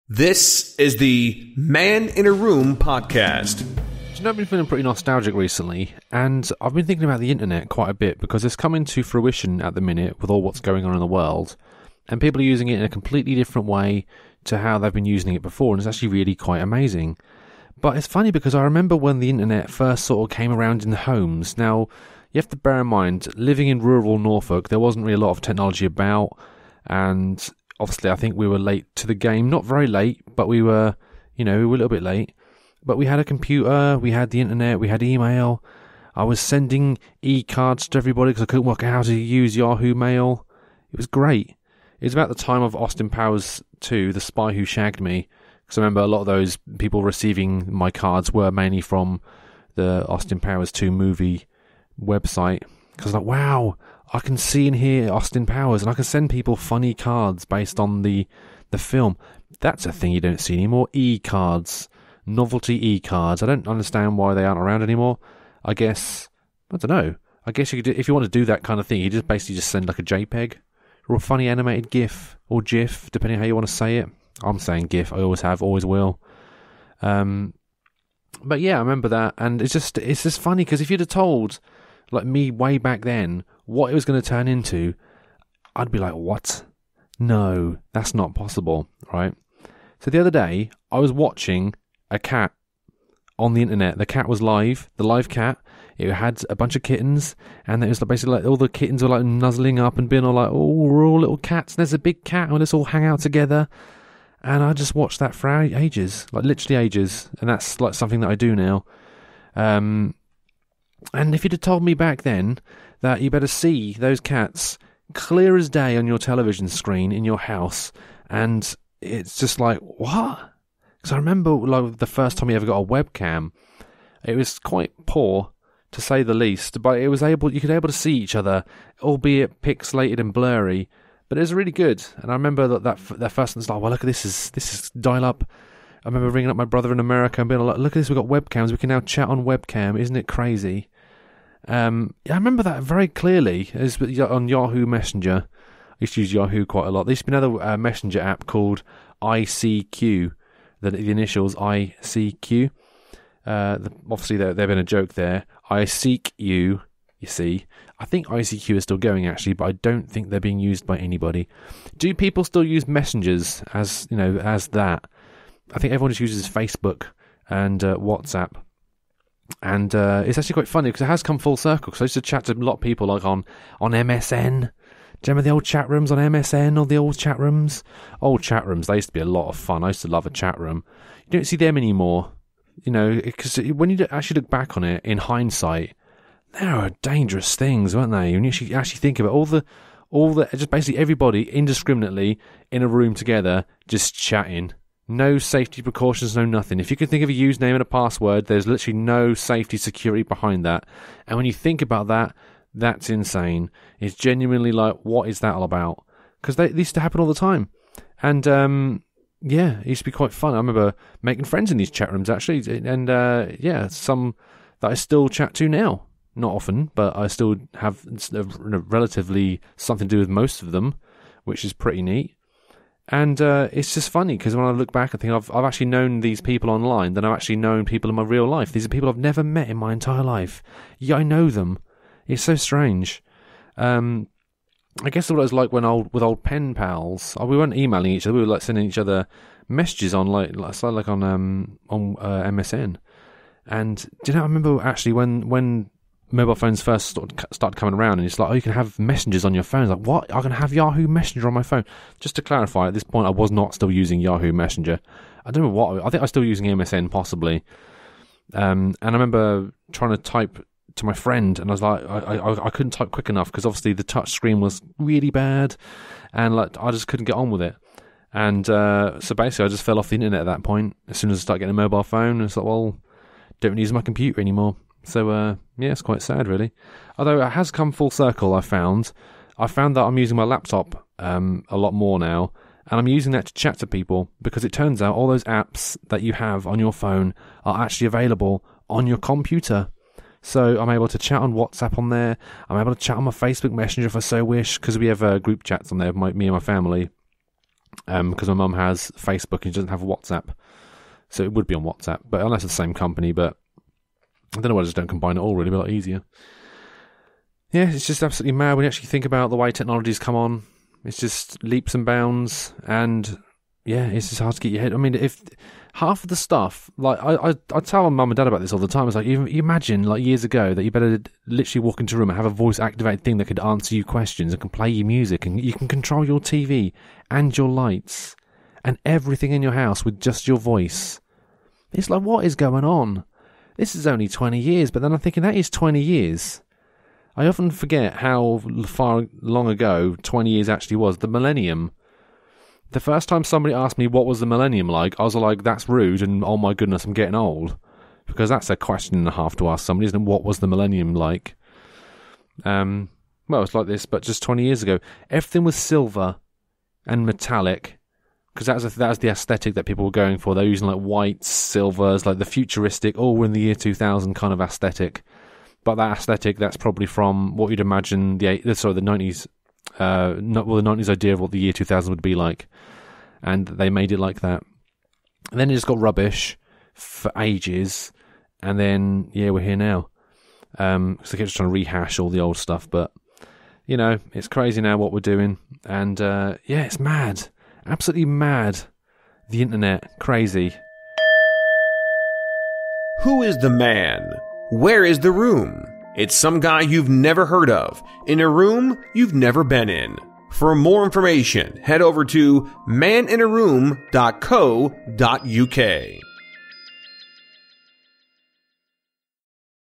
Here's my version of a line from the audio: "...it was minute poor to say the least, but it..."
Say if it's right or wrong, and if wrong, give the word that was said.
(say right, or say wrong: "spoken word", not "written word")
wrong: "quite", not "minute".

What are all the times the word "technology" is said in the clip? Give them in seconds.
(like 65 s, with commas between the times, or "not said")
25 s, 309 s.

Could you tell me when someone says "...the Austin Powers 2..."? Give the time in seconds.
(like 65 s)
49 s.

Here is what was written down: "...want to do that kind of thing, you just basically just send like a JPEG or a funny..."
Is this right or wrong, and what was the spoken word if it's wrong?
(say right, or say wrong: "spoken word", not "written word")
right.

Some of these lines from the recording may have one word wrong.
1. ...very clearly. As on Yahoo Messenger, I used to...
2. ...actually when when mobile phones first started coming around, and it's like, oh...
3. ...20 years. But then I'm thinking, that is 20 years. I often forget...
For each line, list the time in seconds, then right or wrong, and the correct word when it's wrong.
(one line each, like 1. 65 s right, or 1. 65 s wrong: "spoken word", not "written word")
1. 142 s right
2. 244 s right
3. 334 s right.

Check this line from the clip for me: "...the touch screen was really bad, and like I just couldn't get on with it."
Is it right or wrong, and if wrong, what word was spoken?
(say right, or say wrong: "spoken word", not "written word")
right.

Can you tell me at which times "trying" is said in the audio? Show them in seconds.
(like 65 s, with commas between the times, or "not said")
259 s, 381 s.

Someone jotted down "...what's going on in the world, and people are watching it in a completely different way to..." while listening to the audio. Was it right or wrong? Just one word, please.
wrong.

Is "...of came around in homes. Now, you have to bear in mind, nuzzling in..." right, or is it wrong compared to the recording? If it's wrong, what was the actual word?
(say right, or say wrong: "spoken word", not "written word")
wrong: "living", not "nuzzling".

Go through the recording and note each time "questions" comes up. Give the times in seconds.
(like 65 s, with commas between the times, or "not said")
324 s, 348 s.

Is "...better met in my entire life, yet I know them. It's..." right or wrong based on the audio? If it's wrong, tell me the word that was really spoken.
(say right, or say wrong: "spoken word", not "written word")
wrong: "never", not "better".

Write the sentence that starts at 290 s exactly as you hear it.
So I'm able to chat on WhatsApp on there.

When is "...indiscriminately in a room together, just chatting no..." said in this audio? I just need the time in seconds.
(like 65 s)
191 s.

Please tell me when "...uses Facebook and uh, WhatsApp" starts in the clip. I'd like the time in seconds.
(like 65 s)
166 s.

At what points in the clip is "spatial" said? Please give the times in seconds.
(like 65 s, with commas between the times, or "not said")
not said.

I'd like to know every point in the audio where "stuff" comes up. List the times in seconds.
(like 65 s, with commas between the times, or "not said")
316 s, 382 s.